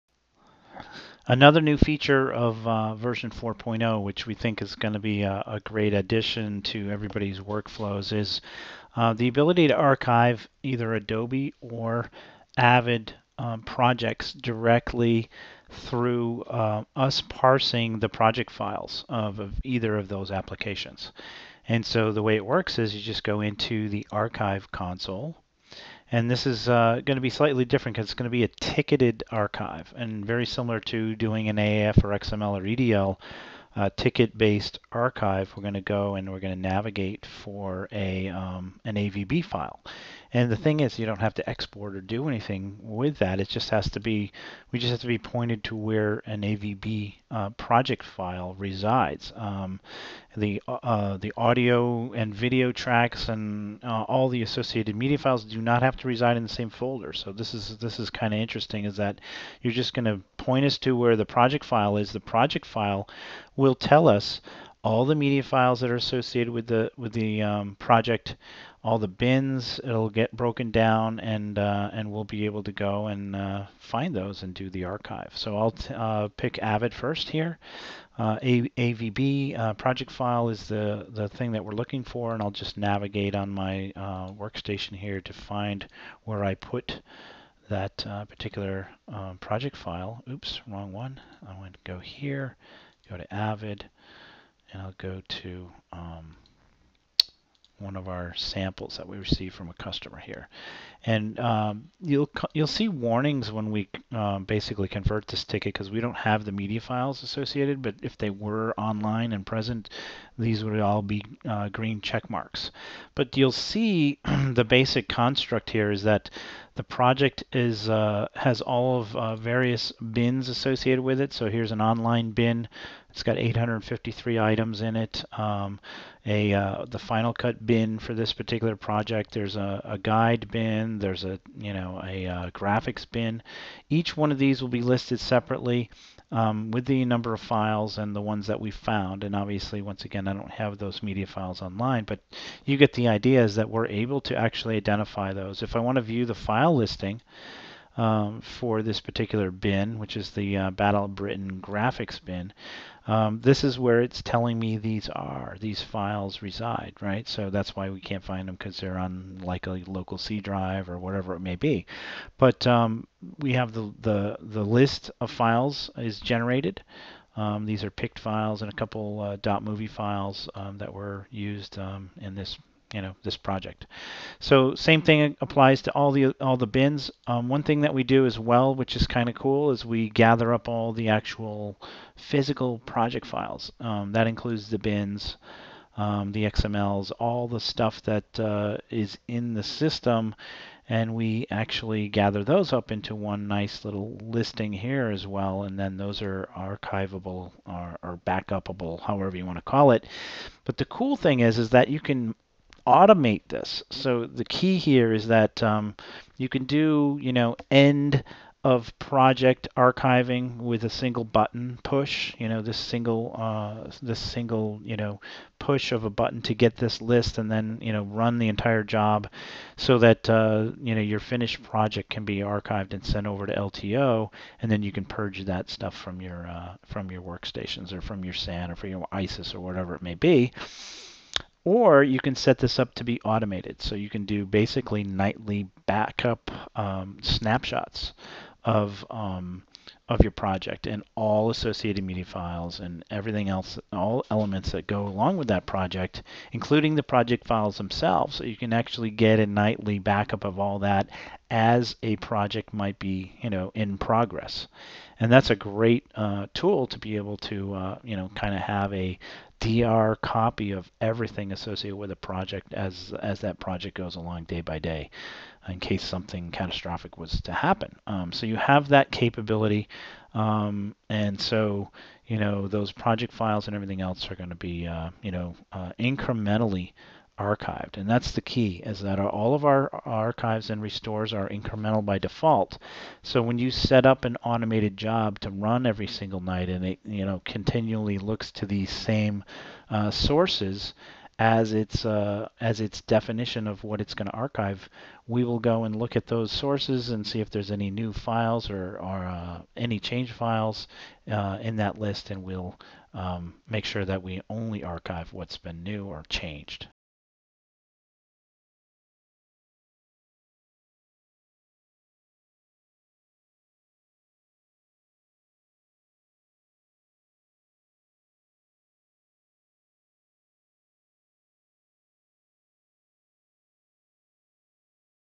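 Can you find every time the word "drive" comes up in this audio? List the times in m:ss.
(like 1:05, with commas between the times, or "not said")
2:40.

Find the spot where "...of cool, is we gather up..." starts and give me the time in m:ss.
2:59.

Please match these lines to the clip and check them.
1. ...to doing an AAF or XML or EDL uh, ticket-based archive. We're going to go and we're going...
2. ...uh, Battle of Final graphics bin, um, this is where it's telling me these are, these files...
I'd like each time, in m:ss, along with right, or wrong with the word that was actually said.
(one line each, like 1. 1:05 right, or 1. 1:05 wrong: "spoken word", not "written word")
1. 0:30 right
2. 2:30 wrong: "Britain", not "Final".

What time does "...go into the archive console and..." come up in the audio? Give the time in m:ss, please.
0:23.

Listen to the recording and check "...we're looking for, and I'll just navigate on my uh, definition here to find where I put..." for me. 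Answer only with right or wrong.
wrong.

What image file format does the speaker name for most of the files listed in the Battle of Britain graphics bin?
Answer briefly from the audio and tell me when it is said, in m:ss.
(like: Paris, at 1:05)
PICT, at 2:47.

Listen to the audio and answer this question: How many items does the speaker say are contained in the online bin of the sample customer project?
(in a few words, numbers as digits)
853.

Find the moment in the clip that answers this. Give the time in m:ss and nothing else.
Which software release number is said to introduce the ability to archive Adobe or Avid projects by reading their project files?
0:02.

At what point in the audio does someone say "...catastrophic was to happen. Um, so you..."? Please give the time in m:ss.
4:26.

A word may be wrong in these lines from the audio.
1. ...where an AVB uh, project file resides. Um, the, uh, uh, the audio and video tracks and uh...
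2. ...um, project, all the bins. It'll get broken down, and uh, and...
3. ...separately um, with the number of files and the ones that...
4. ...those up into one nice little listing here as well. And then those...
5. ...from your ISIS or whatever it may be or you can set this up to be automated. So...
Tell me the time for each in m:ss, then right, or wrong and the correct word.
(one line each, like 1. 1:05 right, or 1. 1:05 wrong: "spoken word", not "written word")
1. 0:45 right
2. 1:07 right
3. 2:15 right
4. 3:12 right
5. 3:48 right.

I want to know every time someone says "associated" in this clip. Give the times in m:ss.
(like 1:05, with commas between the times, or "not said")
0:54, 1:05, 1:47, 2:00, 4:01, 4:21.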